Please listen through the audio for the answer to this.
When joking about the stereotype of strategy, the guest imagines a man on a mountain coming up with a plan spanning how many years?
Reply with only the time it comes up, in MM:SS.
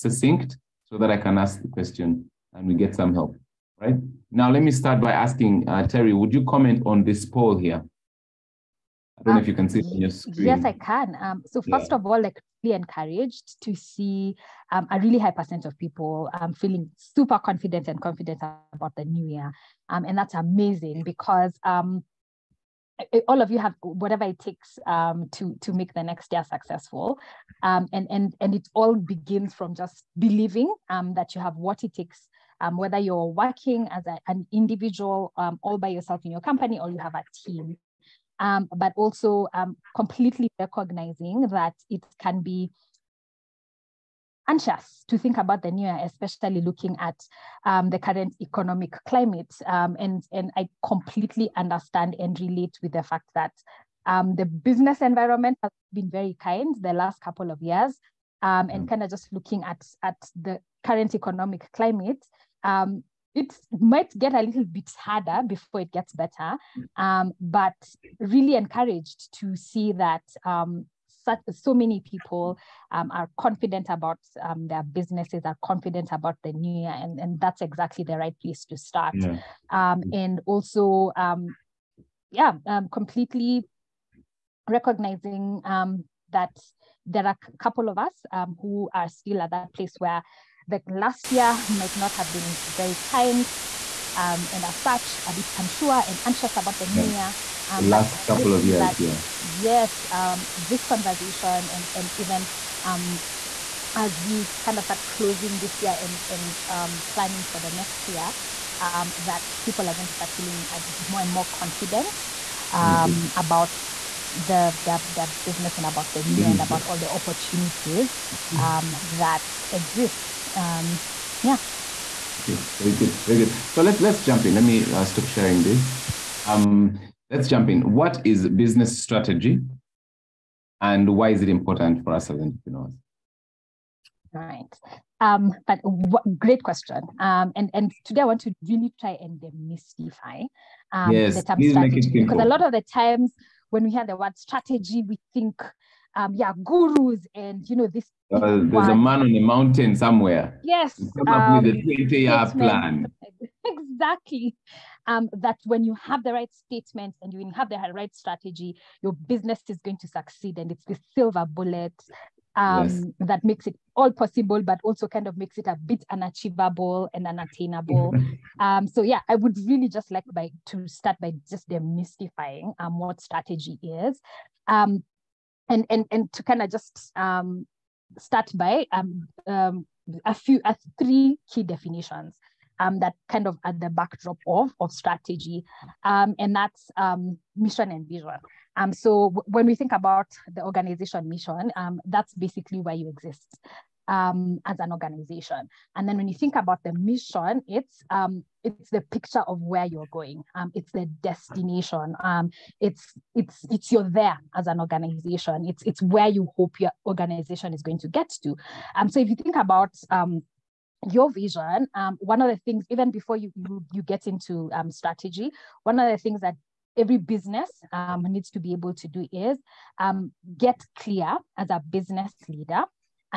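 02:31.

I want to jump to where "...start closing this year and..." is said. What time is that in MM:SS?
01:44.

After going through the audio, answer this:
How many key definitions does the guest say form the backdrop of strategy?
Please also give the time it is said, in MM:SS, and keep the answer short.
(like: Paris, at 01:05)
3, at 03:00.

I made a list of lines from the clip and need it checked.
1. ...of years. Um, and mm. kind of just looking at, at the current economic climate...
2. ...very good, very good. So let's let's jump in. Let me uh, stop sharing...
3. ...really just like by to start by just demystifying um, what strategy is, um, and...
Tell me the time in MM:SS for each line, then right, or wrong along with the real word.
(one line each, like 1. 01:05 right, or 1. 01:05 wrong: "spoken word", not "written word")
1. 00:57 right
2. 02:02 right
3. 02:49 right.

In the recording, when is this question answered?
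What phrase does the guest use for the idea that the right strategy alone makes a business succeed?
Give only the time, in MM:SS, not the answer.
02:41.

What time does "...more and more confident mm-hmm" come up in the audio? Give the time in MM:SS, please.
01:51.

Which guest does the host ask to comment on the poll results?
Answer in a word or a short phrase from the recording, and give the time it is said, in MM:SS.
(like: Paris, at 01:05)
Terry, at 00:05.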